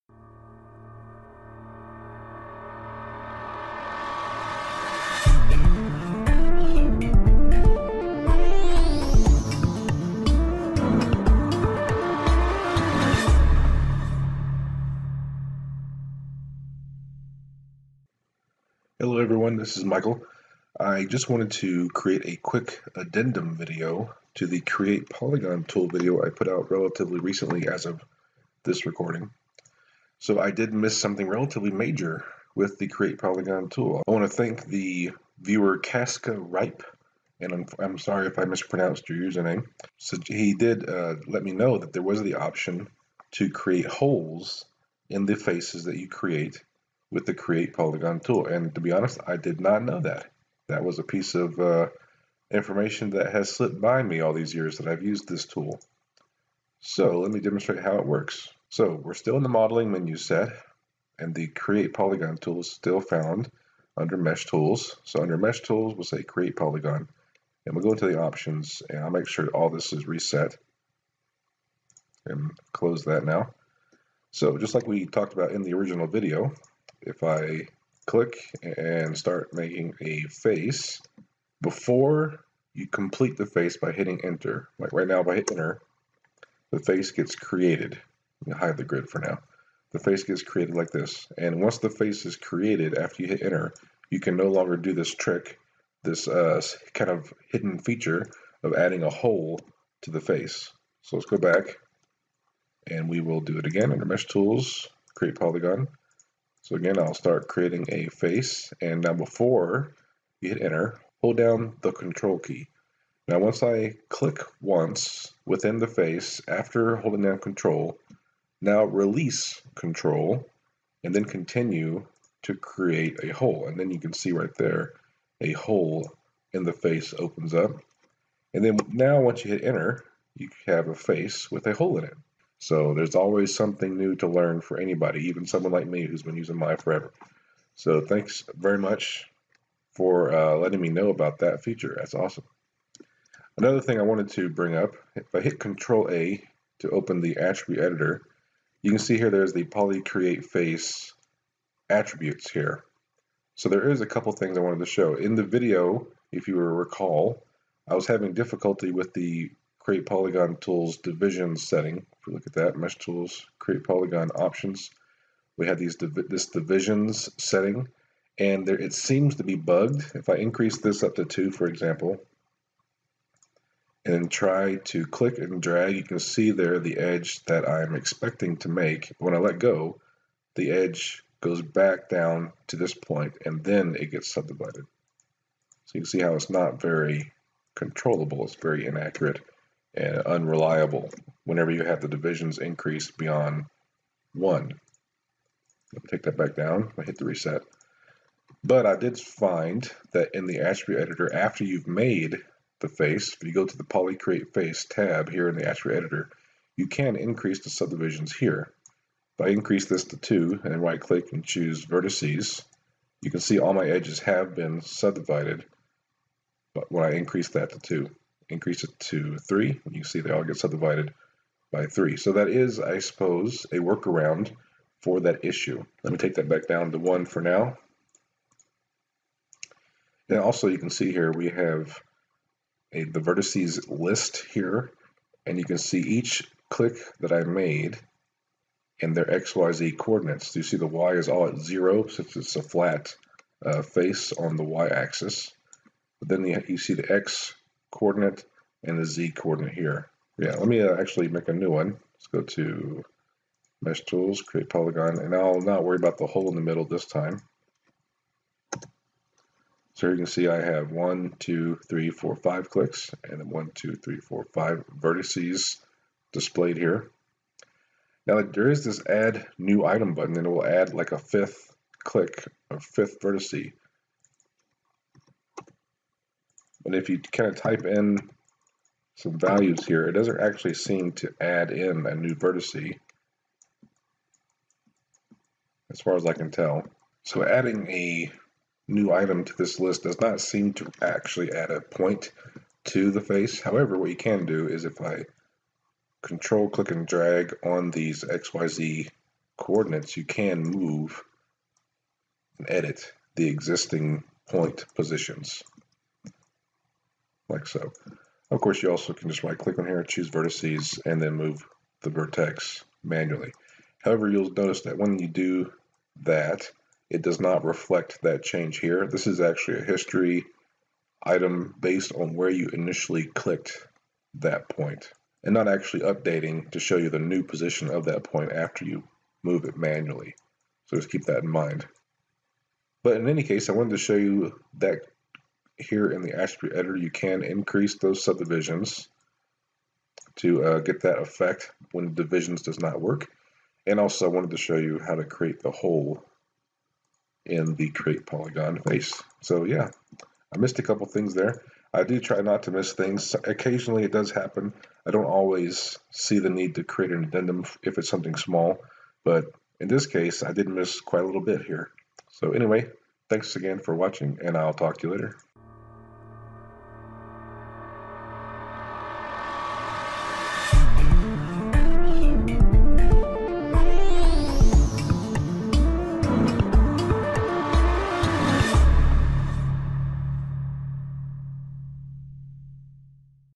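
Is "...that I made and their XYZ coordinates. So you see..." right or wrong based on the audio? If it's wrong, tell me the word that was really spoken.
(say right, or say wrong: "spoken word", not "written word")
right.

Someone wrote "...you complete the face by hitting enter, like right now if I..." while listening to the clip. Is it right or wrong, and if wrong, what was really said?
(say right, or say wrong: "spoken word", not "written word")
right.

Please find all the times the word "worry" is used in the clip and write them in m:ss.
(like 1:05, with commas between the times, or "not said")
4:15.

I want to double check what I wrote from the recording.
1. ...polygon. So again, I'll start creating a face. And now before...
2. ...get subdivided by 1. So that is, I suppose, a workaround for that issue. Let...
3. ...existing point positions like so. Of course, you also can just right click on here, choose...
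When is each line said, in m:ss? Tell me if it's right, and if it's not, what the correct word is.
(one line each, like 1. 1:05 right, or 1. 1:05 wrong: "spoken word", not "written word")
1. 1:45 right
2. 3:40 wrong: "3", not "1"
3. 5:03 right.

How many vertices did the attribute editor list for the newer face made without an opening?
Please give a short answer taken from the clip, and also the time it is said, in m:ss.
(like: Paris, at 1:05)
5, at 4:24.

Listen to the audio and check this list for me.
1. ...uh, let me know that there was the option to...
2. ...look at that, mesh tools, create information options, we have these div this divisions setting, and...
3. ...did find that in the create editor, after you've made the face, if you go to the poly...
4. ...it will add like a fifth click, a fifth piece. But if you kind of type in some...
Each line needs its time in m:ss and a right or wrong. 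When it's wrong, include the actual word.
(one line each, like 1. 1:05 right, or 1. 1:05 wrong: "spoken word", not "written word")
1. 0:40 right
2. 2:42 wrong: "polygon", not "information"
3. 3:18 wrong: "attribute", not "create"
4. 4:30 wrong: "vertice", not "piece".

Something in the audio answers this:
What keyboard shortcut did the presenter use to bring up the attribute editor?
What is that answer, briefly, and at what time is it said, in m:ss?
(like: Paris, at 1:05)
Control A, at 2:25.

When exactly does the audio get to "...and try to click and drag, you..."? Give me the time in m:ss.
2:54.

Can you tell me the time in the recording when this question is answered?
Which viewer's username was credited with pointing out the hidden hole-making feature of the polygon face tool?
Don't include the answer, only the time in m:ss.
0:35.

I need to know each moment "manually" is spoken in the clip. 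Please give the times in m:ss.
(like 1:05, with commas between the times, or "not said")
5:13, 5:29.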